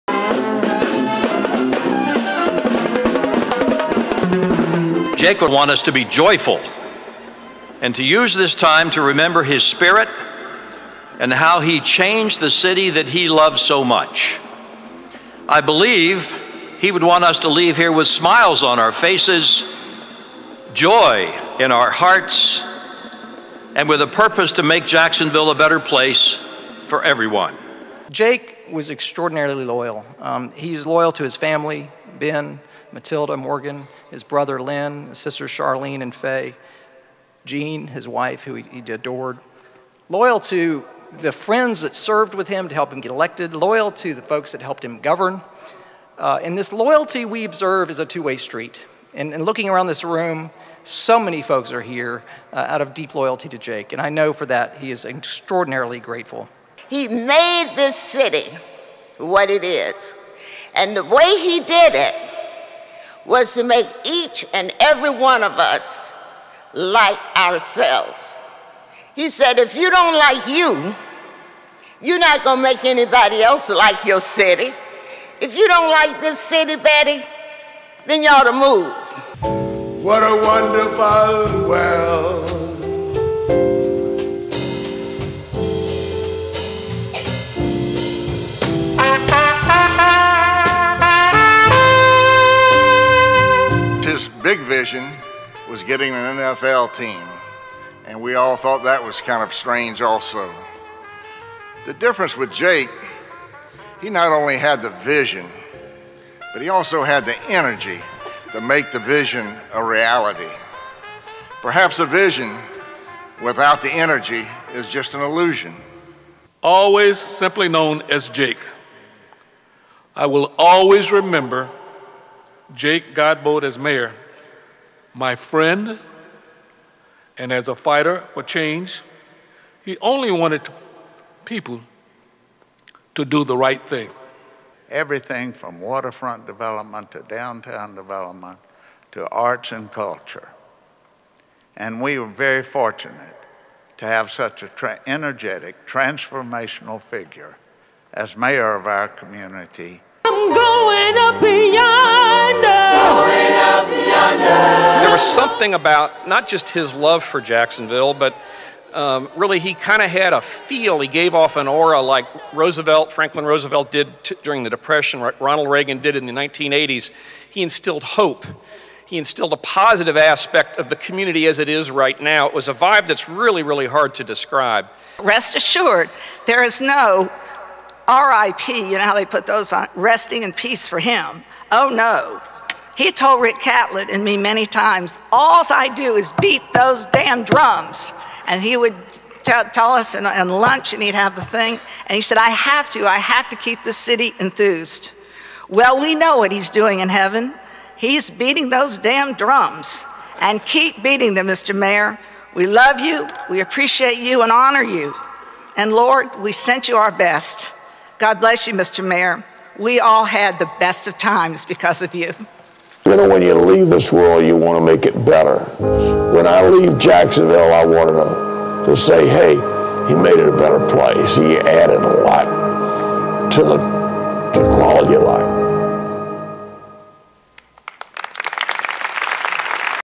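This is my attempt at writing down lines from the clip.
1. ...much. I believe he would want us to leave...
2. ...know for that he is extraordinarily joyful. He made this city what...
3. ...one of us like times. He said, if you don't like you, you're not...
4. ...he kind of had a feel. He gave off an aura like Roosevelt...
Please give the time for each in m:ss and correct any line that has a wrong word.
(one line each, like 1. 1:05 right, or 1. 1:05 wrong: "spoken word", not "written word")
1. 0:13 right
2. 0:54 wrong: "grateful", not "joyful"
3. 1:05 wrong: "ourselves", not "times"
4. 2:39 right.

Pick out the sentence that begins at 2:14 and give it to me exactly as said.
Everything from waterfront development to downtown development to arts and culture.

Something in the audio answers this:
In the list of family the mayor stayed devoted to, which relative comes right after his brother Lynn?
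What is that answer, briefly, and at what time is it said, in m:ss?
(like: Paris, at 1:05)
Charlene, at 0:35.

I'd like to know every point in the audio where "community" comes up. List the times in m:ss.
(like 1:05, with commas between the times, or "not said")
2:29, 2:50.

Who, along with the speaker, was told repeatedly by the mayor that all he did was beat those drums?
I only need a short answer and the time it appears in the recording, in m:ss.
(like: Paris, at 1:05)
Rick Catlett, at 3:03.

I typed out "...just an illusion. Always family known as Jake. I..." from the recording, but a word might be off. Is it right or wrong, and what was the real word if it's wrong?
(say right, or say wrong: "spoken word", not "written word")
wrong: "simply", not "family".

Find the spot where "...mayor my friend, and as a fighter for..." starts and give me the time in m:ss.
2:03.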